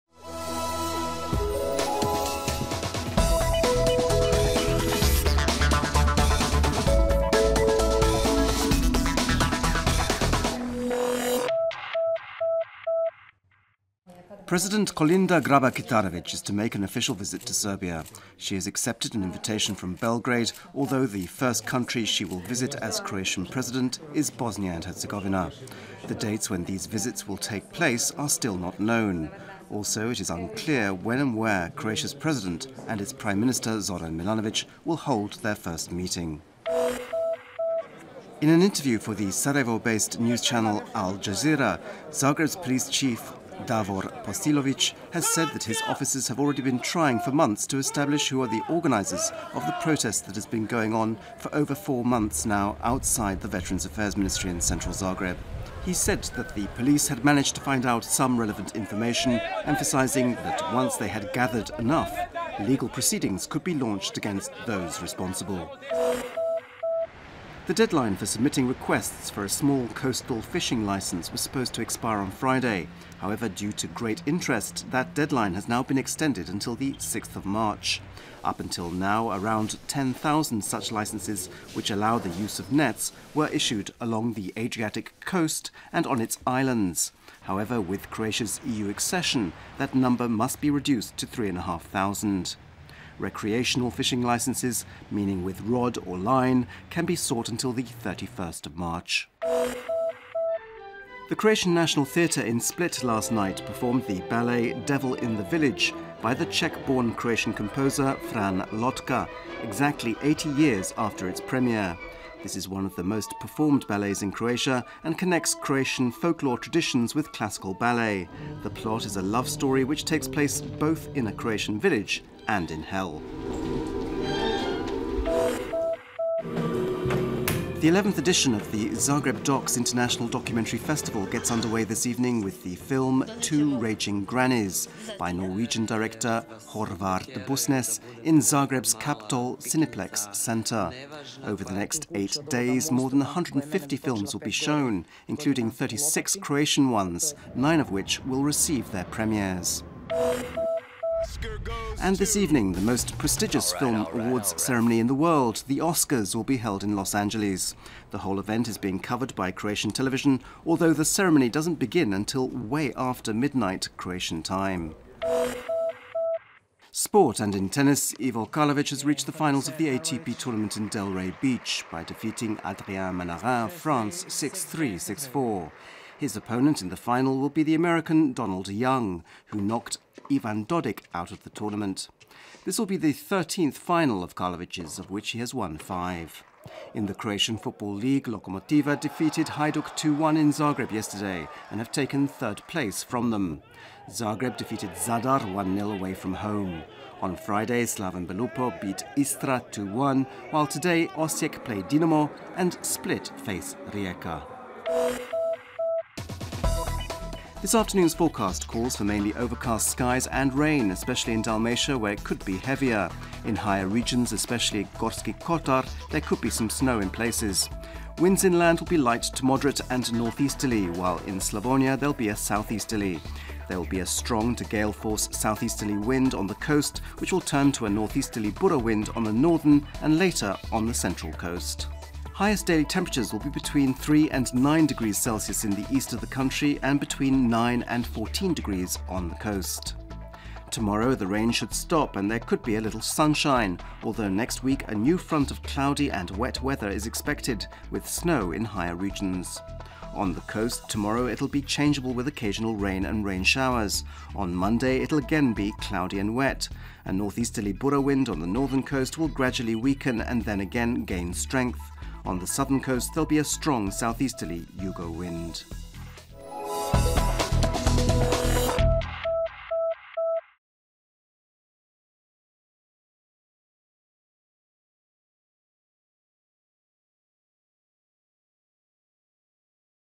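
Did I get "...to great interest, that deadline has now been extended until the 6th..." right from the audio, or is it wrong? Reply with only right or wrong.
right.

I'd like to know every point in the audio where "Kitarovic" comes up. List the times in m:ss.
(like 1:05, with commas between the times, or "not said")
0:15.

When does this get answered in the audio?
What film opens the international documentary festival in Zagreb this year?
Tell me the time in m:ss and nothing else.
2:13.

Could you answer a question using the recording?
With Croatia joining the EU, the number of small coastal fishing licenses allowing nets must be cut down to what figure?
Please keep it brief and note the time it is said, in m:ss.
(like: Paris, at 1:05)
3,500, at 1:31.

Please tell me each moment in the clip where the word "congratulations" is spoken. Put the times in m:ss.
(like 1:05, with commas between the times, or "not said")
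not said.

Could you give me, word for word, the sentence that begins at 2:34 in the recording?
ceremony in the world, the Oscars, will be held in Los Angeles.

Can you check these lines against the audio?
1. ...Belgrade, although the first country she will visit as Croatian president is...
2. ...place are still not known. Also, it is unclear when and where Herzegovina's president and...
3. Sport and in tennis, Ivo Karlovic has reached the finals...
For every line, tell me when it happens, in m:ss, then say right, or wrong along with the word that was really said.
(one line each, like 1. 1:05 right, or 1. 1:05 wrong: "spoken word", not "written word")
1. 0:19 right
2. 0:27 wrong: "Croatia", not "Herzegovina"
3. 2:46 right.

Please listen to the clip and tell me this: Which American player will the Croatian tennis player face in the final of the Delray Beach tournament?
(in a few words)
Donald Young.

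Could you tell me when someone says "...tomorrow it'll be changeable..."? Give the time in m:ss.
4:10.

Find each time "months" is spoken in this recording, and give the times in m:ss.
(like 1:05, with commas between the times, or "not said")
0:47, 0:52.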